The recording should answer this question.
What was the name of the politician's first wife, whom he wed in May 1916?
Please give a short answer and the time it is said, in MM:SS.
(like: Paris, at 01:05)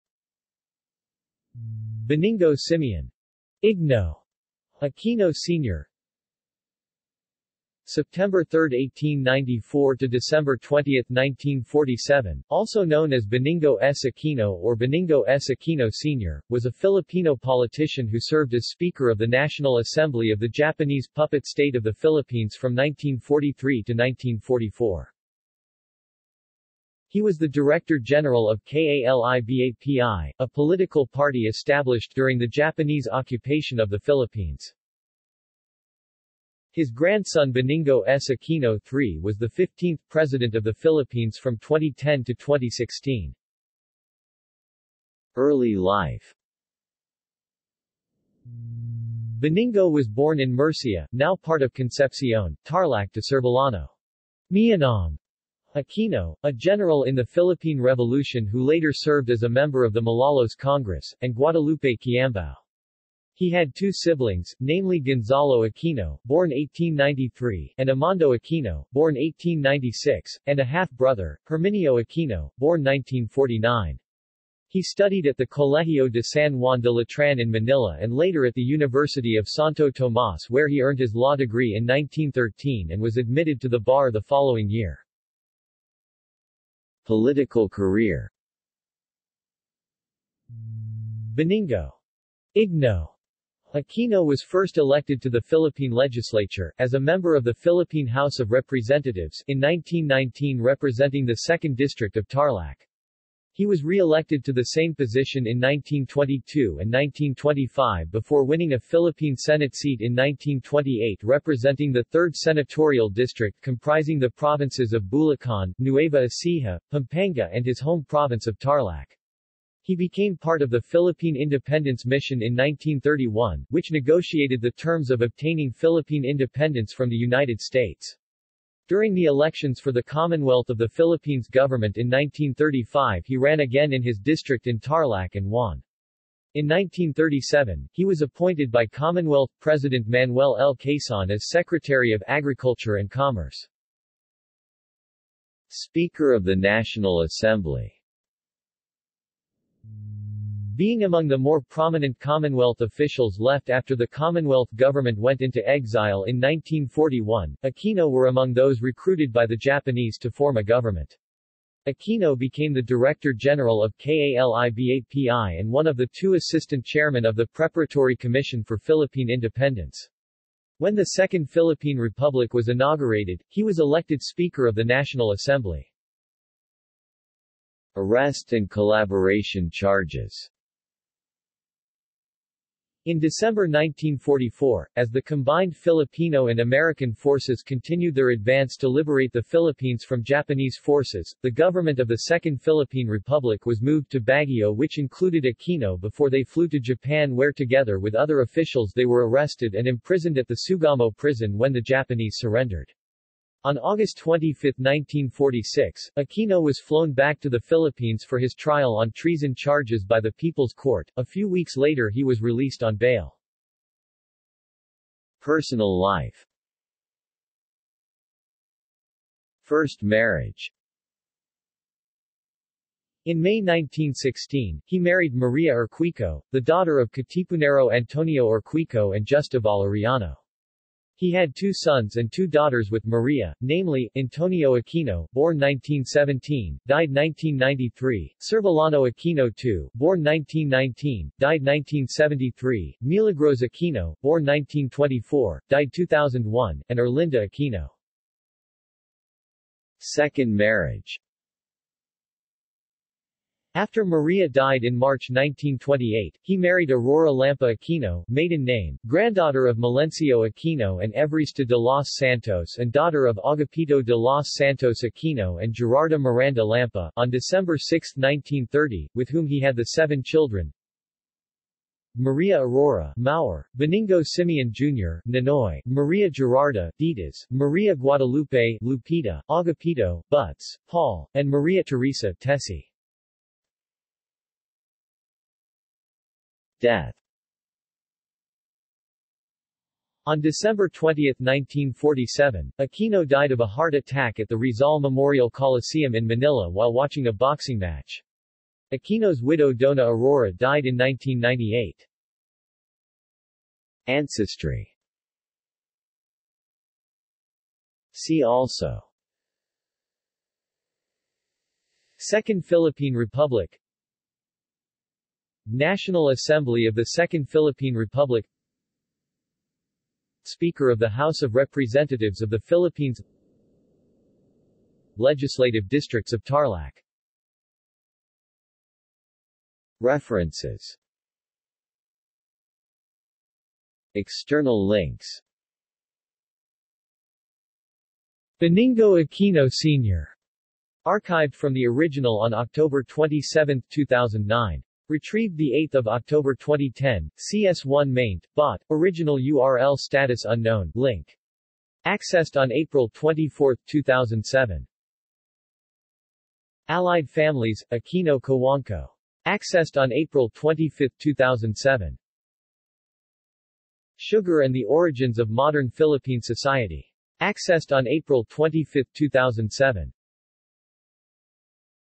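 Maria Orquico, at 03:45.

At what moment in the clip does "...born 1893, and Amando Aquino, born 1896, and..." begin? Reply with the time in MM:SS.
01:06.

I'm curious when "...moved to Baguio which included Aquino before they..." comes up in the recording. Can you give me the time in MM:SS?
03:13.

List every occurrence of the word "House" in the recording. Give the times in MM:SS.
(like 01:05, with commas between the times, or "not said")
01:38, 05:21.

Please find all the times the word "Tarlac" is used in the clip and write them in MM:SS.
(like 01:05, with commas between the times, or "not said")
00:52, 01:42, 01:58, 02:14, 05:26.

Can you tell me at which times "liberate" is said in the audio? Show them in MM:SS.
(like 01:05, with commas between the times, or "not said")
03:08.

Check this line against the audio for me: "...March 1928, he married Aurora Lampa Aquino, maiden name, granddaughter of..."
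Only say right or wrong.
right.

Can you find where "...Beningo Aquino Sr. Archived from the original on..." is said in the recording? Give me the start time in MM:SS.
05:38.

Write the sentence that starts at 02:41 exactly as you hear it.
Aquino became the Director General of KALIBAPI and one of the two assistant chairmen of the Preparatory Commission for Philippine Independence.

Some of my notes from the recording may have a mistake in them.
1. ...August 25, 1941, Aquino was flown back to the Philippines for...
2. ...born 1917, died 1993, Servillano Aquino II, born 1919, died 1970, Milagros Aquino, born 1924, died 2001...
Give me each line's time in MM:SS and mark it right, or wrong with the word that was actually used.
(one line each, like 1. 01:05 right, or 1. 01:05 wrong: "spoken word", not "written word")
1. 03:23 wrong: "1946", not "1941"
2. 03:55 wrong: "1973", not "1970".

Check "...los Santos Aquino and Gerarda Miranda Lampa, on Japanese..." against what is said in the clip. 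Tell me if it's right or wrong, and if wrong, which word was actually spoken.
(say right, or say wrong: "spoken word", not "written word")
wrong: "December", not "Japanese".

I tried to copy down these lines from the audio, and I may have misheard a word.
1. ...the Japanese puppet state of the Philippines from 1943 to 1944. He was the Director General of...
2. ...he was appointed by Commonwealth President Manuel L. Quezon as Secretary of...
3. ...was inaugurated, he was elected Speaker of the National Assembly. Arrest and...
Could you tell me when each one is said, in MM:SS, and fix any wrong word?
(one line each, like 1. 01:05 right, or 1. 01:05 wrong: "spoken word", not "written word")
1. 00:20 right
2. 02:17 right
3. 02:52 right.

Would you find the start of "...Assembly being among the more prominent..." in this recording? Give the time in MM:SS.
02:27.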